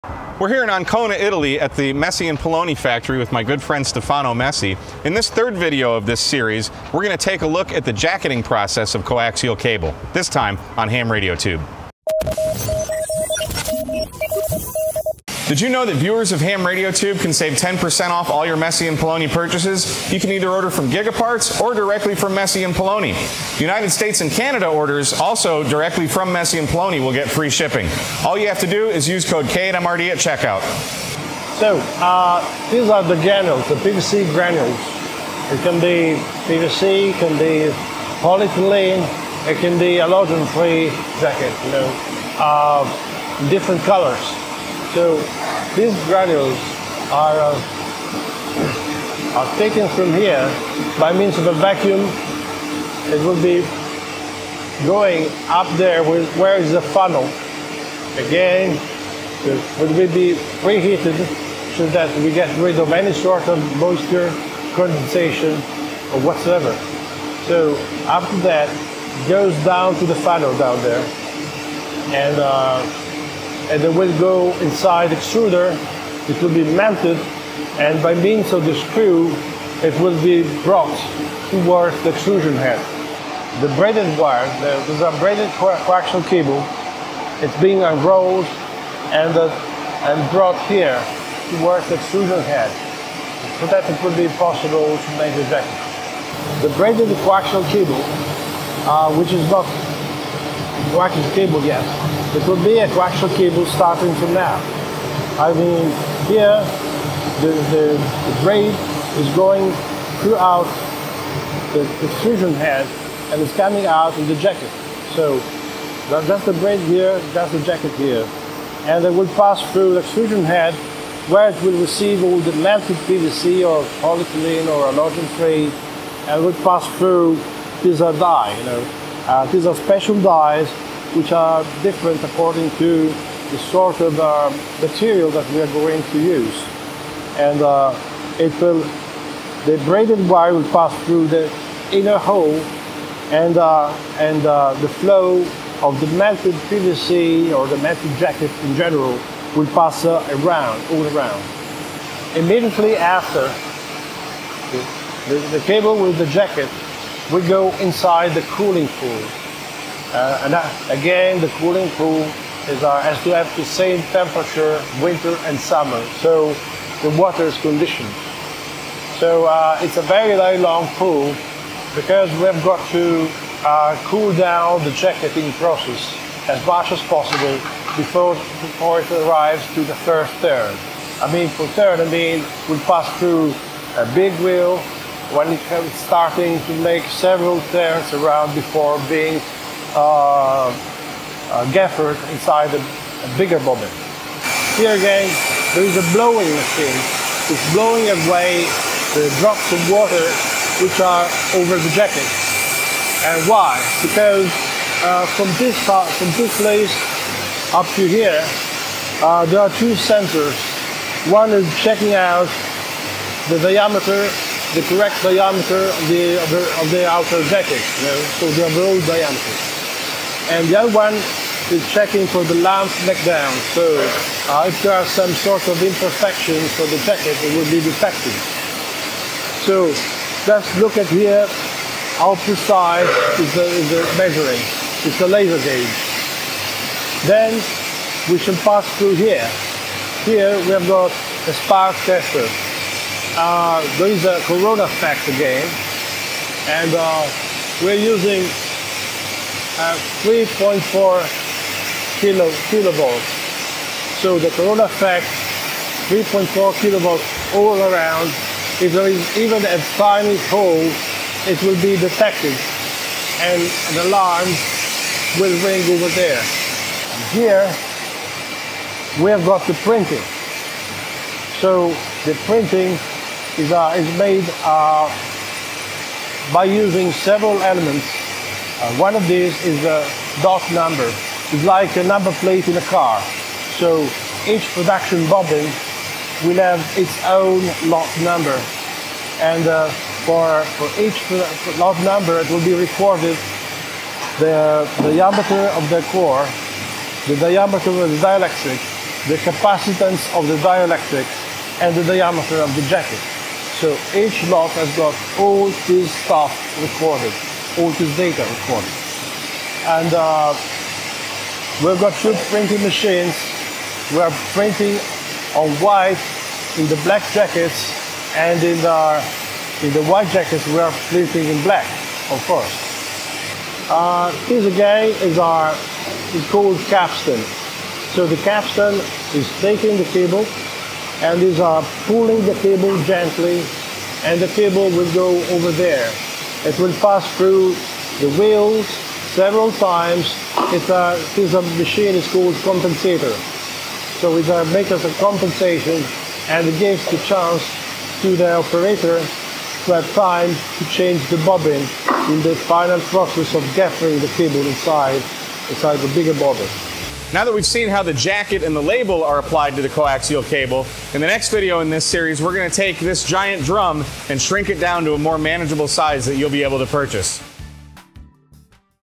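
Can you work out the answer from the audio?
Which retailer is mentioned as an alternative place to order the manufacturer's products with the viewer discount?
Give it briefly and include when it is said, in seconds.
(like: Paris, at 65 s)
Gigaparts, at 20 s.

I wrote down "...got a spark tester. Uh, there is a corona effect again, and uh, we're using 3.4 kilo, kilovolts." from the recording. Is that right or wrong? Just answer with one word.
right.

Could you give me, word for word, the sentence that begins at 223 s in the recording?
So uh, if there are some sort of imperfections for the jacket, it will be detected.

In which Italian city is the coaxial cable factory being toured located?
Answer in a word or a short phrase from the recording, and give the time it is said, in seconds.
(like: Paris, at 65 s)
Ancona, at 0 s.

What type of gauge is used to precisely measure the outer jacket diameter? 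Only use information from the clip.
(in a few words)
laser gauge.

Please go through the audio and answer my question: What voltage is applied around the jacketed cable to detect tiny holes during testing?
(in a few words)
3.4 kilovolts.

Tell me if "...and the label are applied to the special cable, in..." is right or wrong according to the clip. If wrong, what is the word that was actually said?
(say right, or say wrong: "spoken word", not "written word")
wrong: "coaxial", not "special".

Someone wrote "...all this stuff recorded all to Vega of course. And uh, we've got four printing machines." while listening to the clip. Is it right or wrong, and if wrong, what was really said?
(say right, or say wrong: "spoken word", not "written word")
wrong: "two", not "four".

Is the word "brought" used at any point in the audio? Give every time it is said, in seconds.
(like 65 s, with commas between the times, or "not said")
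80 s, 90 s.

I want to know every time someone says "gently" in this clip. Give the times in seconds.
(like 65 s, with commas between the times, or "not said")
333 s.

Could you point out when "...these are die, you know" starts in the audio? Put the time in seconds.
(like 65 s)
127 s.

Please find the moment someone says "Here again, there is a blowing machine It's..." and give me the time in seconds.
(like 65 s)
194 s.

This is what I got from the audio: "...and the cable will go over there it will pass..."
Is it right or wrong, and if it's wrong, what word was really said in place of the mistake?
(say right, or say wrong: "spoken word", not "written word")
right.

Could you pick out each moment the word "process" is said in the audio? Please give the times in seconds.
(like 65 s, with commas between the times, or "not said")
8 s, 175 s, 352 s.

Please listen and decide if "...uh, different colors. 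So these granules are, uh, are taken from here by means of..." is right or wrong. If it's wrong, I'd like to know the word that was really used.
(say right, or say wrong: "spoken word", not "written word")
right.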